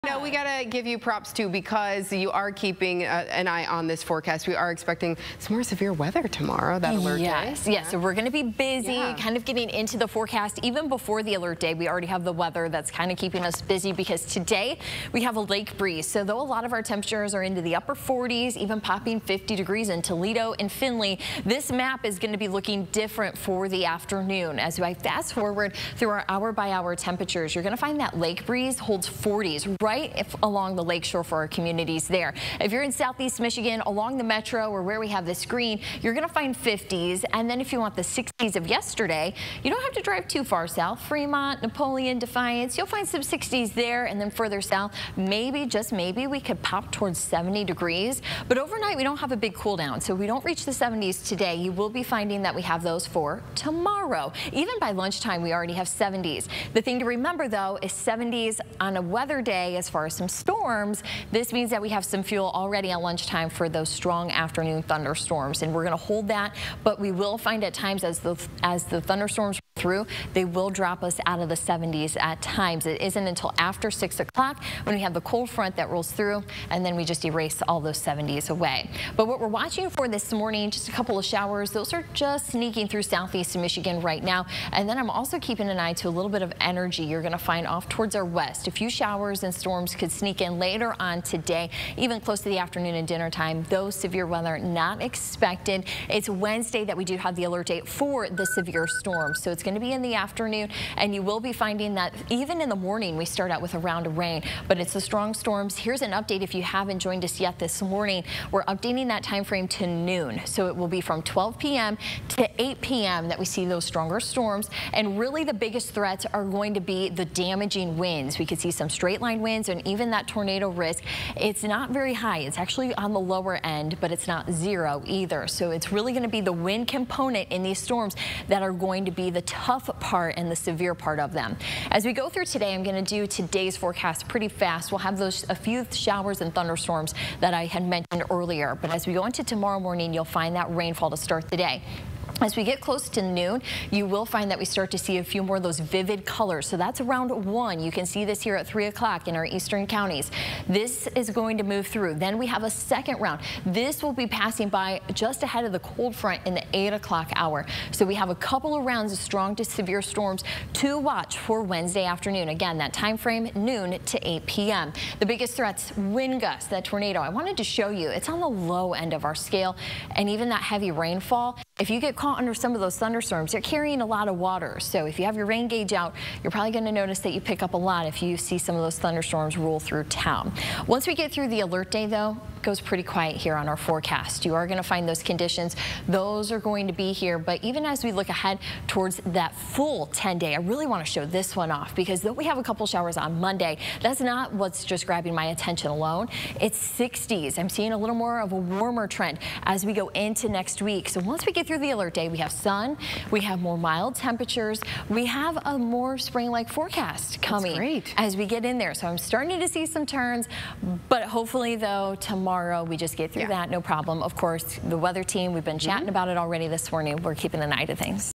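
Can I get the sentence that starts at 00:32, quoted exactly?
If you're in southeast Michigan, along the metro or where we have the screen, you're going to find 50s.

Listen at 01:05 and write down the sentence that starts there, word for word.
And we're going to hold that, but we will find at times as the, as the thunderstorms through.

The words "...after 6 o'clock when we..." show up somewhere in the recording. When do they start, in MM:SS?
01:13.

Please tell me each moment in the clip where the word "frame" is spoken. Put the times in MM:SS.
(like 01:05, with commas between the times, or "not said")
01:49, 02:43.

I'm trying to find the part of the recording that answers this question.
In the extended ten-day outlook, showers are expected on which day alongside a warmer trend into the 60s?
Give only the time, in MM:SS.
03:13.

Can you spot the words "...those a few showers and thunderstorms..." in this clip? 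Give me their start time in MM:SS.
02:15.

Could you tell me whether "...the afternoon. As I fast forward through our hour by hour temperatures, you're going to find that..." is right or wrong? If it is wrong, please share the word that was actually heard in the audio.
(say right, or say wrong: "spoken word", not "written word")
right.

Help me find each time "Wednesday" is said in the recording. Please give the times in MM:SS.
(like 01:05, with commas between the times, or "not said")
01:36, 02:41.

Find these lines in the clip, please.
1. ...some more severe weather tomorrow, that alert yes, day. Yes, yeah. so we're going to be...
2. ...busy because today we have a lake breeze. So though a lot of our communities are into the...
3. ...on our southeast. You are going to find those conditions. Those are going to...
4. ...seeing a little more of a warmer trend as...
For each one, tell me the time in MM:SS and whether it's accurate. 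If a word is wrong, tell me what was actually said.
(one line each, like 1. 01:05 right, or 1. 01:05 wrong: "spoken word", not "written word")
1. 00:05 right
2. 00:13 wrong: "temperatures", not "communities"
3. 03:03 wrong: "forecast", not "southeast"
4. 03:17 right.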